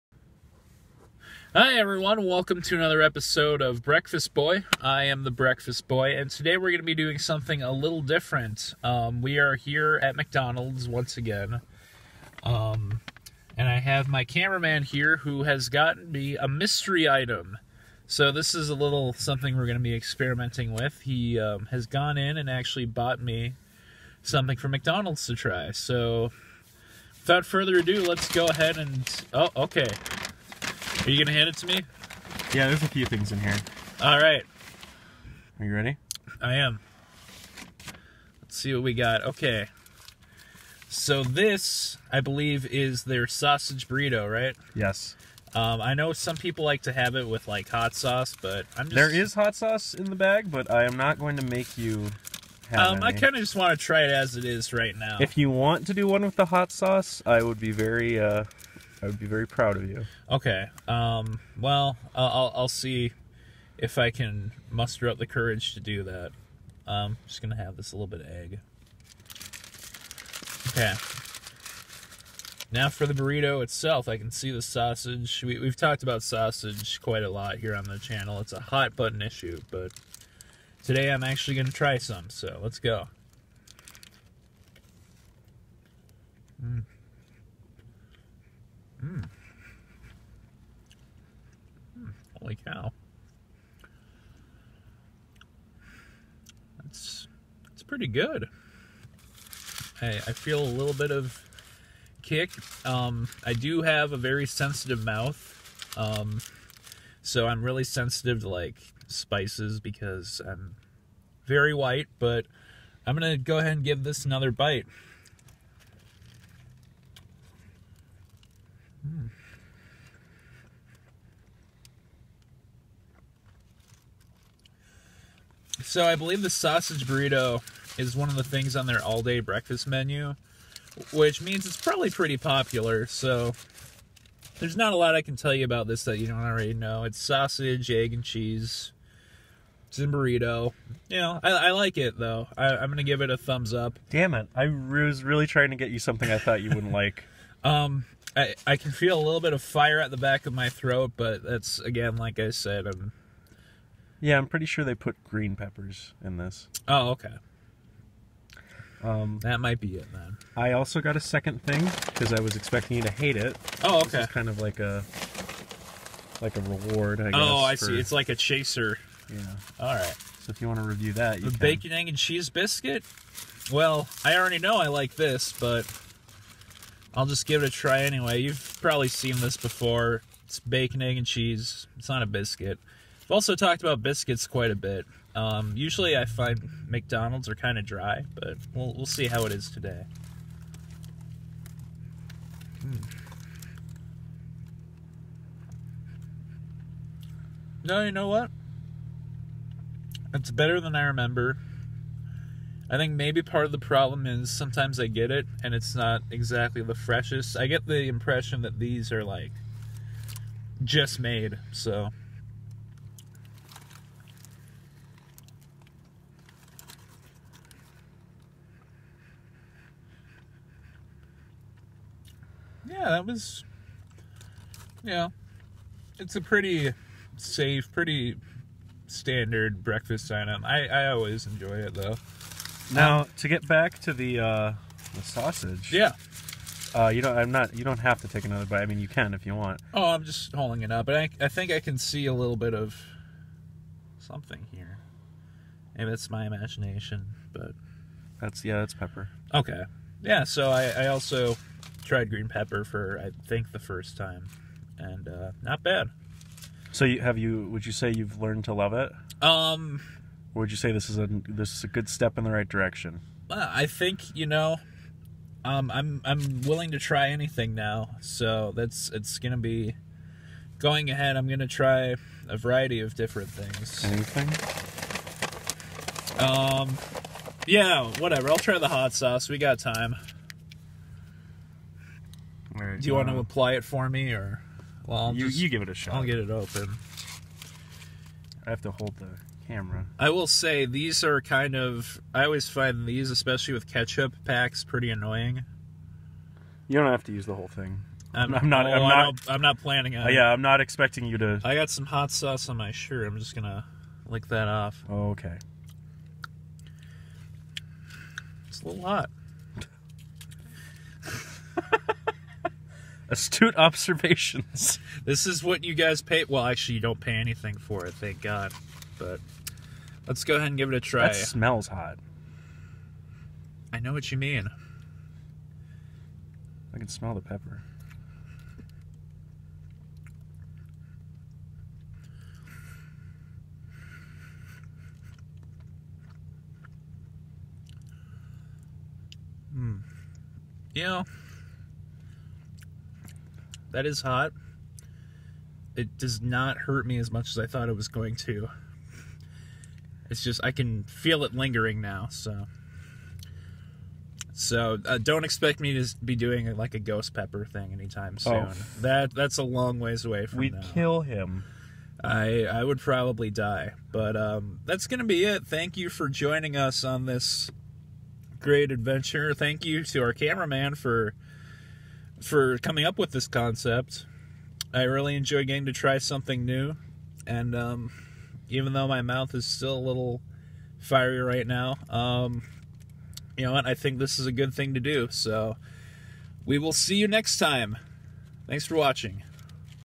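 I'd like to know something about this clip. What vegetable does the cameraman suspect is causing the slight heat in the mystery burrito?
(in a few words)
Green peppers.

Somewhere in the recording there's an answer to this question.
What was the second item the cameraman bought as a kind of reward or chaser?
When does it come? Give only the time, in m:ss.
2:51.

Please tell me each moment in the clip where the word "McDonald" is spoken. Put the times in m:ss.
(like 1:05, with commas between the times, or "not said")
0:10, 0:24, 3:06.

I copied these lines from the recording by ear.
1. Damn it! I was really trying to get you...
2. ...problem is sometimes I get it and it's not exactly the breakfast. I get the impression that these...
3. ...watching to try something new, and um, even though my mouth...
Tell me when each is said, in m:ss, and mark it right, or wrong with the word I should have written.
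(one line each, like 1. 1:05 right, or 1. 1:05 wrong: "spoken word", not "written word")
1. 2:24 right
2. 3:23 wrong: "freshest", not "breakfast"
3. 6:15 wrong: "getting", not "watching".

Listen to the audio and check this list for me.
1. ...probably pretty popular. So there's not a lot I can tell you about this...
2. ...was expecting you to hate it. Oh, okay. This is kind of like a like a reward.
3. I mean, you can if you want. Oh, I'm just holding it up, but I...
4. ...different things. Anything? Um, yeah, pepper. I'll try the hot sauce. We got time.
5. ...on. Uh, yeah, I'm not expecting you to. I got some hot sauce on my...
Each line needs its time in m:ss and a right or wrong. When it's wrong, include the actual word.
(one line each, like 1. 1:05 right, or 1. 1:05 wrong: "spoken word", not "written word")
1. 2:11 right
2. 2:42 right
3. 3:58 right
4. 4:33 wrong: "whatever", not "pepper"
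5. 5:00 right.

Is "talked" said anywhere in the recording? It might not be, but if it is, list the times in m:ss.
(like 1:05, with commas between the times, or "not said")
1:15, 3:03.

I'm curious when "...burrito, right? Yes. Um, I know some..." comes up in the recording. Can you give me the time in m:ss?
0:43.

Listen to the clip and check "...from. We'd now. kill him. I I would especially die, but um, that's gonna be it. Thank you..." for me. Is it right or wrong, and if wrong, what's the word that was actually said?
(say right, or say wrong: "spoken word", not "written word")
wrong: "probably", not "especially".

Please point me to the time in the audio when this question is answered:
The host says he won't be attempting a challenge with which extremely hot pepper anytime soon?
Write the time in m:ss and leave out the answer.
5:56.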